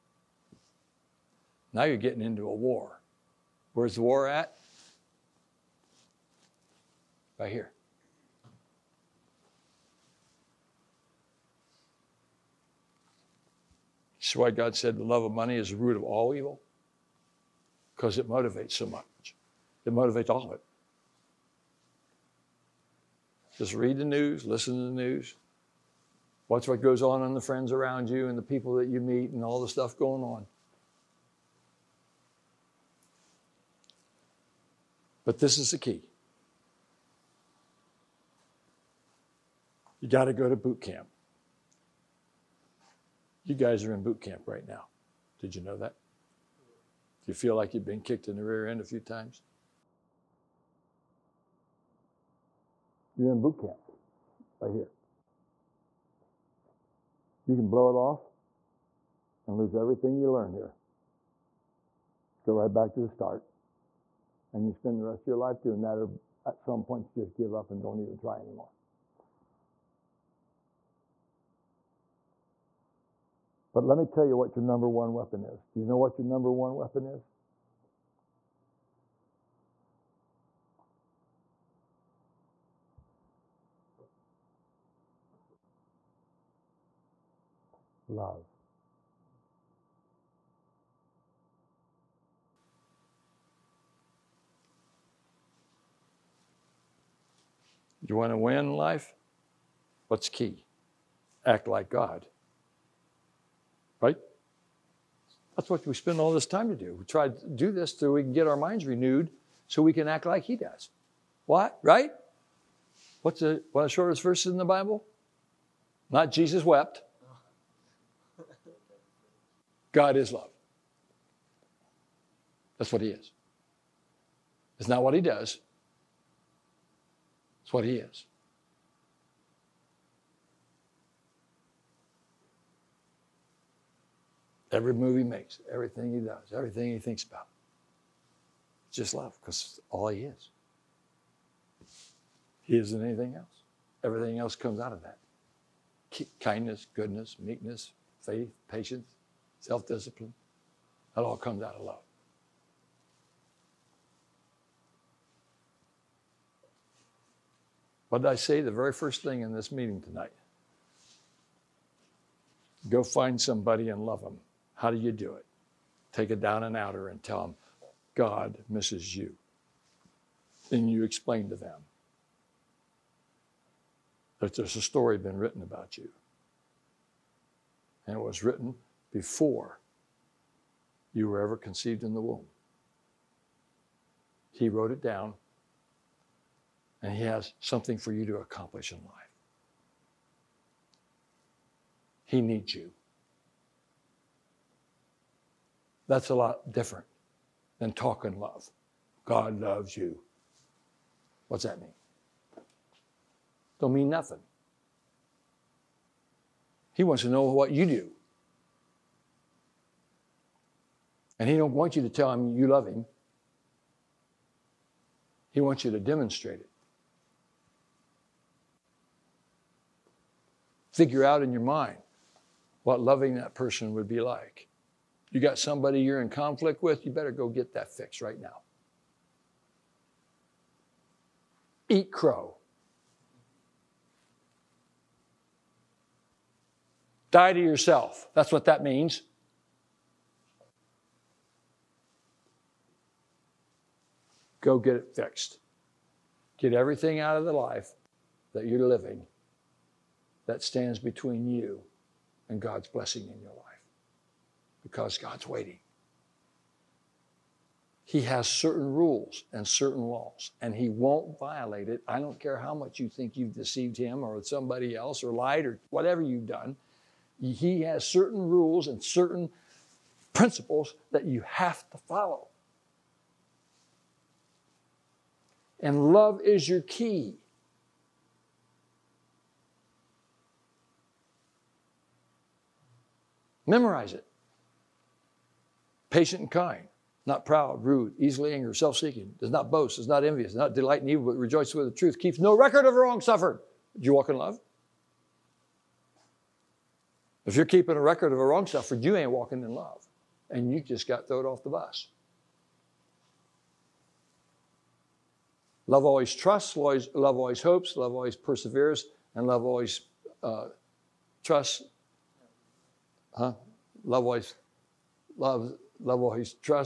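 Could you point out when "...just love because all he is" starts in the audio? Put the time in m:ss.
2:18.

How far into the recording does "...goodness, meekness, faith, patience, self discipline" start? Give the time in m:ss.
2:26.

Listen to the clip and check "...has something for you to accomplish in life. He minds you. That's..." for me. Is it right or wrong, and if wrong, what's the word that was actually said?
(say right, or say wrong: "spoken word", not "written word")
wrong: "needs", not "minds".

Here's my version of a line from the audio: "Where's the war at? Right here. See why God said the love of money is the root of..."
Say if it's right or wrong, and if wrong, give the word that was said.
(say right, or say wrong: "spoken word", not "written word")
right.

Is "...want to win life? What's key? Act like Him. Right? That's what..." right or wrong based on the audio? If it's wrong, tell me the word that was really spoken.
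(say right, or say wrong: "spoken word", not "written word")
wrong: "God", not "Him".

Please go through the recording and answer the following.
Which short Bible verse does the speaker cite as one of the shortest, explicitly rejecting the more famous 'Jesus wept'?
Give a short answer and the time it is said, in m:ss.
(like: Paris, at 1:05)
God is love, at 1:59.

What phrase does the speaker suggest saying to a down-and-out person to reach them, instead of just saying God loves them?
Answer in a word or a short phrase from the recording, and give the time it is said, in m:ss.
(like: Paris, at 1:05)
God misses you, at 2:48.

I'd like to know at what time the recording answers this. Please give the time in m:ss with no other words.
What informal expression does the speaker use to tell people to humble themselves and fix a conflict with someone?
3:51.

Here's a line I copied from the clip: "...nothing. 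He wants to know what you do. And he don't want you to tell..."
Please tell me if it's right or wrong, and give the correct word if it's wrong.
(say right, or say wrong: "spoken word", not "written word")
right.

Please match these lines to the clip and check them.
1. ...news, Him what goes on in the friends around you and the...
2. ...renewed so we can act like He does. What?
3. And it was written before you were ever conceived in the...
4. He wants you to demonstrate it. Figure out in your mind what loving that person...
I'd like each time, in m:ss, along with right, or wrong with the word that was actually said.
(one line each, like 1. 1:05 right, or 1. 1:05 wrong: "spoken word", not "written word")
1. 0:25 wrong: "Watch", not "Him"
2. 1:48 right
3. 2:58 right
4. 3:35 right.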